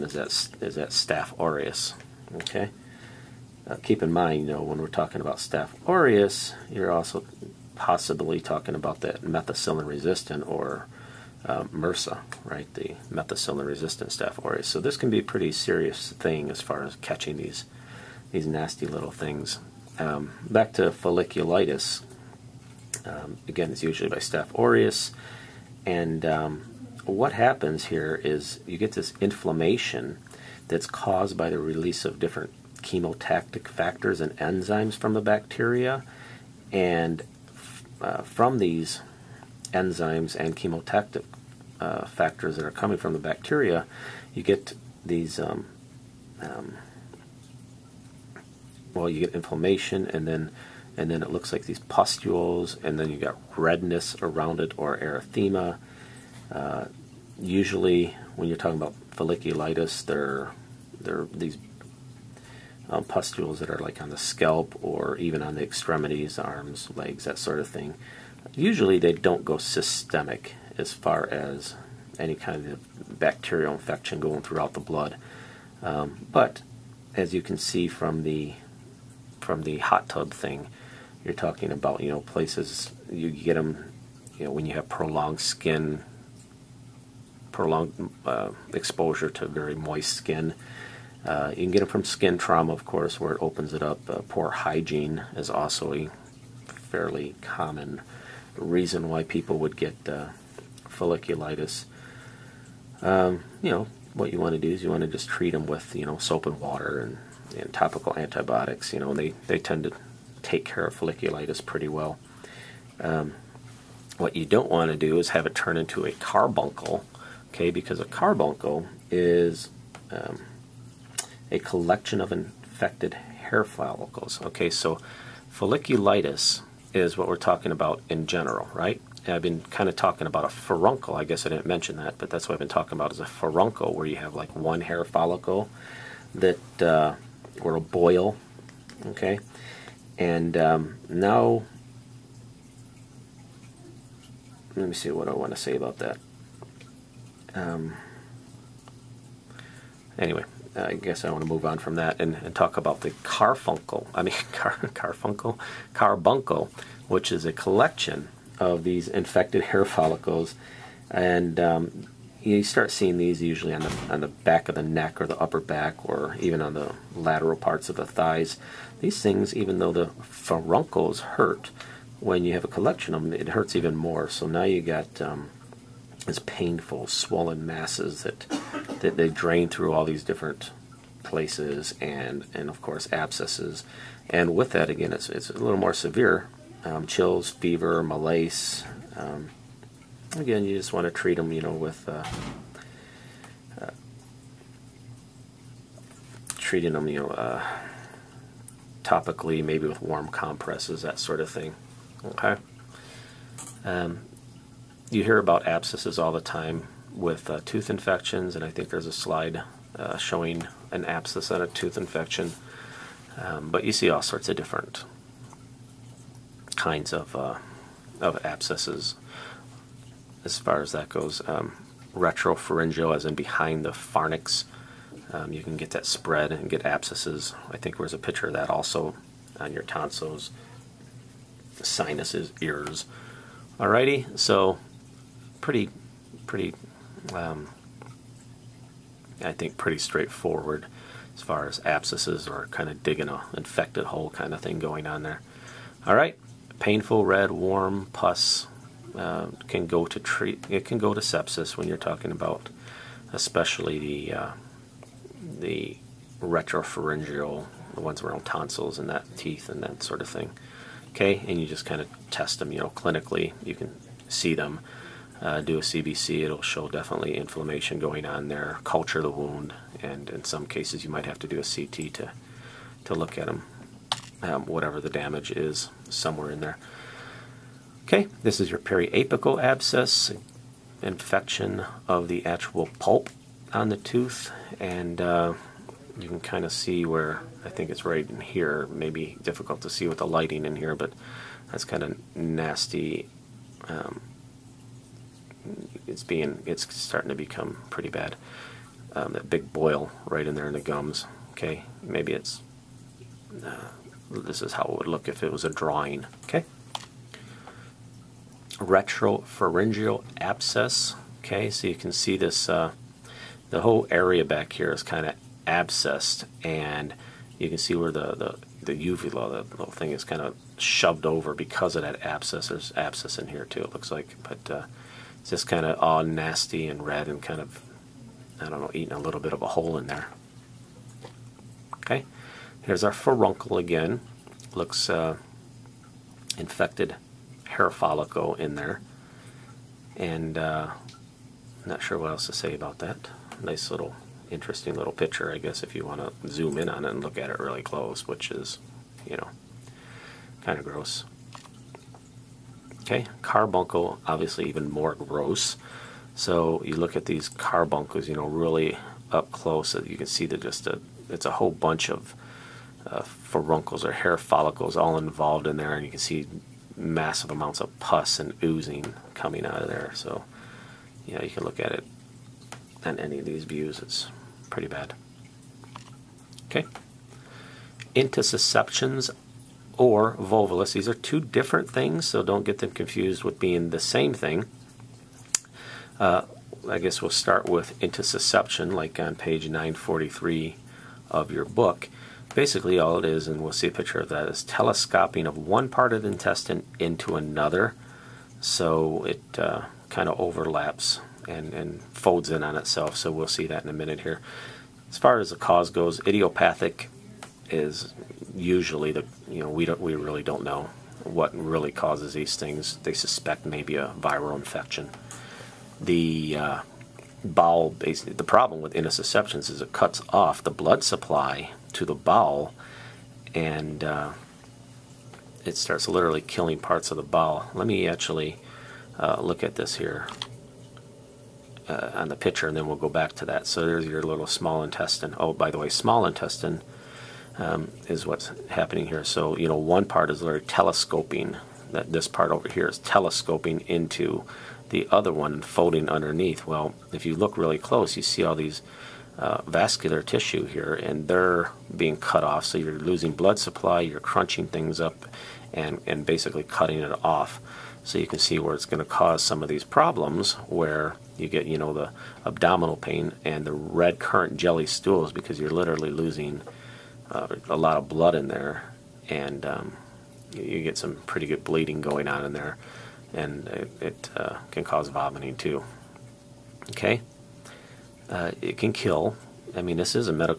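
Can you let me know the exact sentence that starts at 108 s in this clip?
You know, they, they tend to take care of folliculitis pretty well.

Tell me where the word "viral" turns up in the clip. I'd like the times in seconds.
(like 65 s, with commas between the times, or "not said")
414 s.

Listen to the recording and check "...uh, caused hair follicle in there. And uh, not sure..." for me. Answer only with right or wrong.
wrong.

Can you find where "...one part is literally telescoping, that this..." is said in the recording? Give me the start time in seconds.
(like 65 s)
439 s.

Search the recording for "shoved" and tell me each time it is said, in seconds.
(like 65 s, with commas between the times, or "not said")
320 s.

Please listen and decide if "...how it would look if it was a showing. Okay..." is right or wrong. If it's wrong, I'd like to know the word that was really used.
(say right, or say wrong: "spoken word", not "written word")
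wrong: "drawing", not "showing".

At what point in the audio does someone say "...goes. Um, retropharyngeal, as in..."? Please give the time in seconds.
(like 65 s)
221 s.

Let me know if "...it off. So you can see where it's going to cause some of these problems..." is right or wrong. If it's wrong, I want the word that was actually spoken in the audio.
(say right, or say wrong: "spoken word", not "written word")
right.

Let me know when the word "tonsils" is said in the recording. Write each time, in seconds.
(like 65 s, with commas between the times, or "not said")
229 s, 258 s.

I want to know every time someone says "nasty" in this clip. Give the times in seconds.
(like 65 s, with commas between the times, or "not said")
18 s, 292 s, 326 s.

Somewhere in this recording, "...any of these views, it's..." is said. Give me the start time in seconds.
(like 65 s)
373 s.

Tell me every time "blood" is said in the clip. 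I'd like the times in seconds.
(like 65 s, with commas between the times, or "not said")
74 s, 420 s, 453 s, 468 s.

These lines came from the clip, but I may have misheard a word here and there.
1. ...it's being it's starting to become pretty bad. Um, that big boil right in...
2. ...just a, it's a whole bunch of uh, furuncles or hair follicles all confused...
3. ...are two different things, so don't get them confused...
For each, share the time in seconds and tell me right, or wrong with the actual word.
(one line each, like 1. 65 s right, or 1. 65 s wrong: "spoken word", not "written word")
1. 296 s right
2. 360 s wrong: "involved", not "confused"
3. 381 s right.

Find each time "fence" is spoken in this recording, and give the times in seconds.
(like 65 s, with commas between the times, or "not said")
not said.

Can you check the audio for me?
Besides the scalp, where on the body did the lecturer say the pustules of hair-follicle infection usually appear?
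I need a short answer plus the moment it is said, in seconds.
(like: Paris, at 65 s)
extremities, at 65 s.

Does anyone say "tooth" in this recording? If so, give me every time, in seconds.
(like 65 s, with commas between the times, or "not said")
207 s, 211 s, 283 s.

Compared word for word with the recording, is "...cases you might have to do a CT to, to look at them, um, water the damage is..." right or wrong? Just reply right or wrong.
wrong.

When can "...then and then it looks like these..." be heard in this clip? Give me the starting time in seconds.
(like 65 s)
50 s.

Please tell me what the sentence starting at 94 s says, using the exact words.
Uh, poor hygiene is also a fairly common reason why people would get uh, folliculitis.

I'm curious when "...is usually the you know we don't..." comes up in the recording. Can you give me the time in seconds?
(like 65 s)
407 s.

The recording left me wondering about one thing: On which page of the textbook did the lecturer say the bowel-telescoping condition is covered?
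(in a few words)
943.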